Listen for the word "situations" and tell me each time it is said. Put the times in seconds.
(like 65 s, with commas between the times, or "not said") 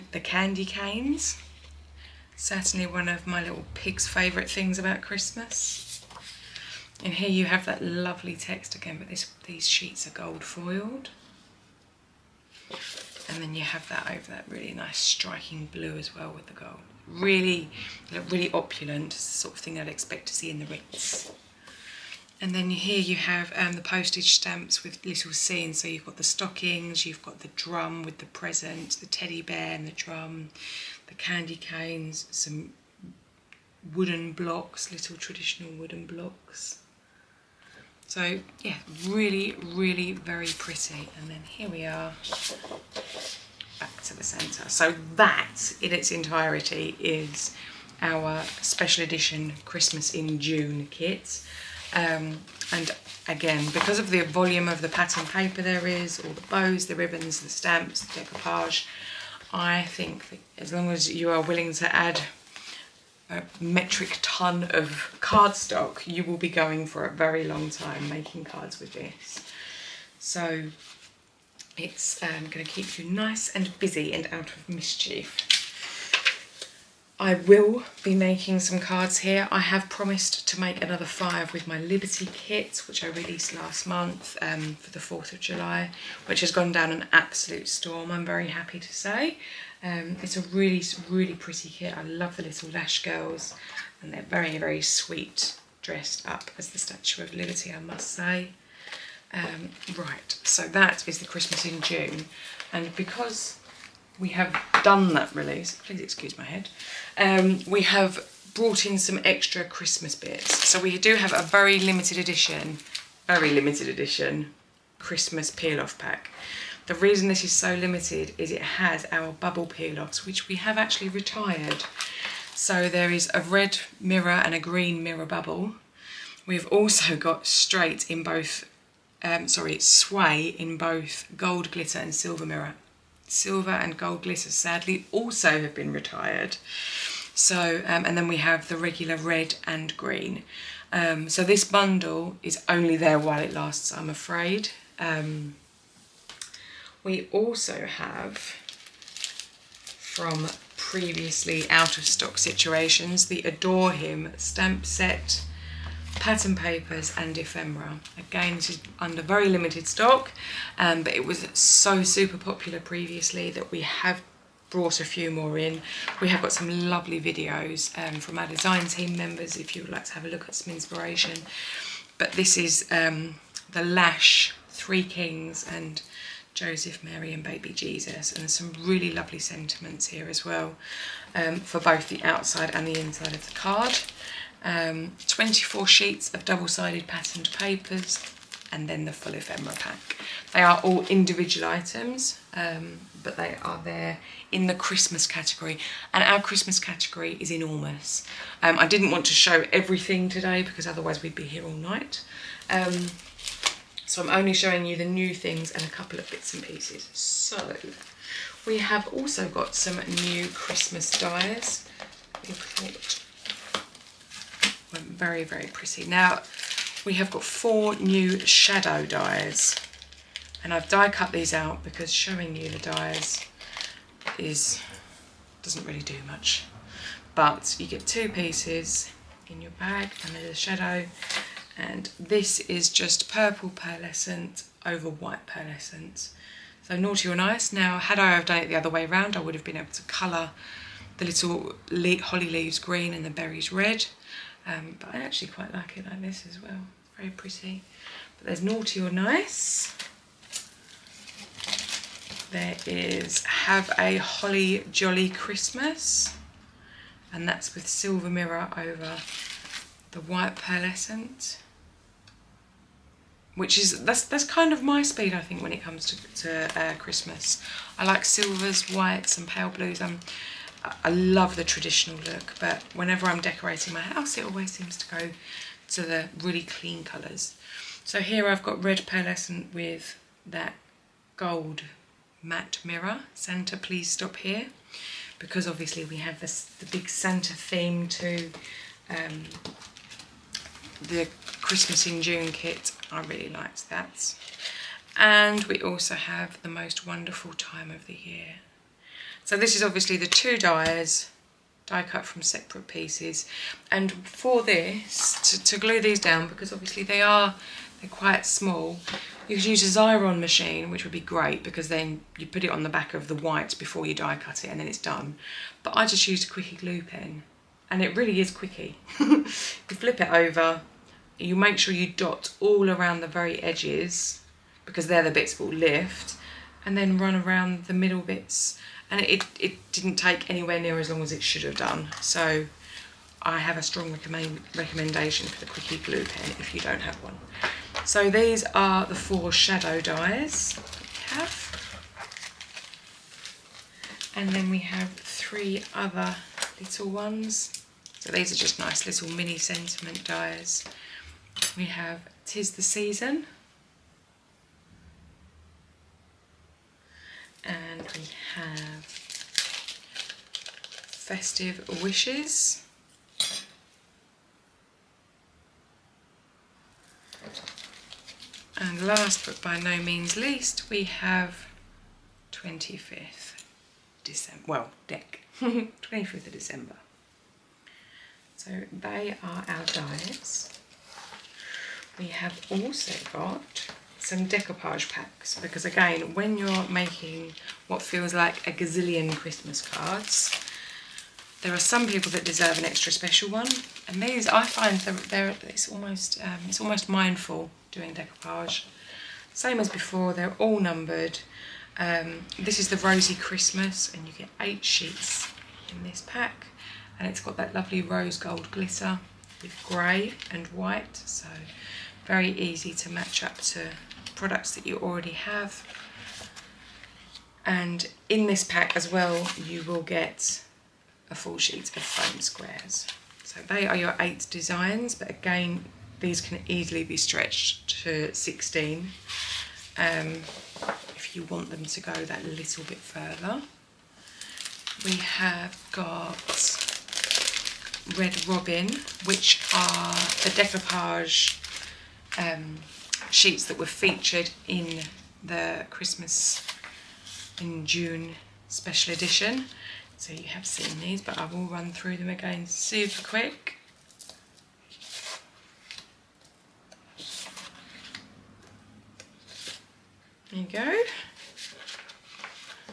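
152 s.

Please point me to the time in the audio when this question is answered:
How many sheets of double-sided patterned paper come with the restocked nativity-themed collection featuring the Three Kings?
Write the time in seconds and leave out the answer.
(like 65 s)
185 s.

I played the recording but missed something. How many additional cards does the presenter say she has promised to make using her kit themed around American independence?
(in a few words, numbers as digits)
5.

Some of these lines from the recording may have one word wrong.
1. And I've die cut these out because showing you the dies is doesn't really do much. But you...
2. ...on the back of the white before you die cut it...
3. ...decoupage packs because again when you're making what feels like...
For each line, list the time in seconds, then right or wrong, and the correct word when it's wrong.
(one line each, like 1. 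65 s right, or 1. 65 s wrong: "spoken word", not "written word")
1. 220 s right
2. 312 s right
3. 384 s right.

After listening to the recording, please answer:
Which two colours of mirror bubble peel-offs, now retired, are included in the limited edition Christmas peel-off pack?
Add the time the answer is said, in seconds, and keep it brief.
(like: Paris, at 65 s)
Red and green, at 123 s.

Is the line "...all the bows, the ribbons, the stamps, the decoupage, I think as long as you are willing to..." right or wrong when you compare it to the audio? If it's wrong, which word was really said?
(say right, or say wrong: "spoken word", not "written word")
right.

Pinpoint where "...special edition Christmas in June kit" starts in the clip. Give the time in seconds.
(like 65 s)
48 s.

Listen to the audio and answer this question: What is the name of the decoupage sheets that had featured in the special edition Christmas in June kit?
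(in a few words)
Red Robin.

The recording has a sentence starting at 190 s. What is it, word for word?
They are all individual items, um, but they are there in the Christmas category.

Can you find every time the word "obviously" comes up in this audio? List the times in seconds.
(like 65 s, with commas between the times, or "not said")
285 s, 299 s, 306 s.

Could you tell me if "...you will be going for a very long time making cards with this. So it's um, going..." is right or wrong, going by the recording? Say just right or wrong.
right.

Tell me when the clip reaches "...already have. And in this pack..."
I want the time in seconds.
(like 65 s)
414 s.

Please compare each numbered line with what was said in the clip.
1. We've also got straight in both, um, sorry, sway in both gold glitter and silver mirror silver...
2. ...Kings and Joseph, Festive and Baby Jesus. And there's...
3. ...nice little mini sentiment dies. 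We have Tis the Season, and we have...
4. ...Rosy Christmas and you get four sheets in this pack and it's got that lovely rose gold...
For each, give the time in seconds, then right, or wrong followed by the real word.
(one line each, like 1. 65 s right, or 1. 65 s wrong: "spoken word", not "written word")
1. 126 s right
2. 175 s wrong: "Mary", not "Festive"
3. 348 s right
4. 402 s wrong: "eight", not "four".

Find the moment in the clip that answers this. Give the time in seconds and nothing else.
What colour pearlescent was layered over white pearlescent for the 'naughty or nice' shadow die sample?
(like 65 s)
233 s.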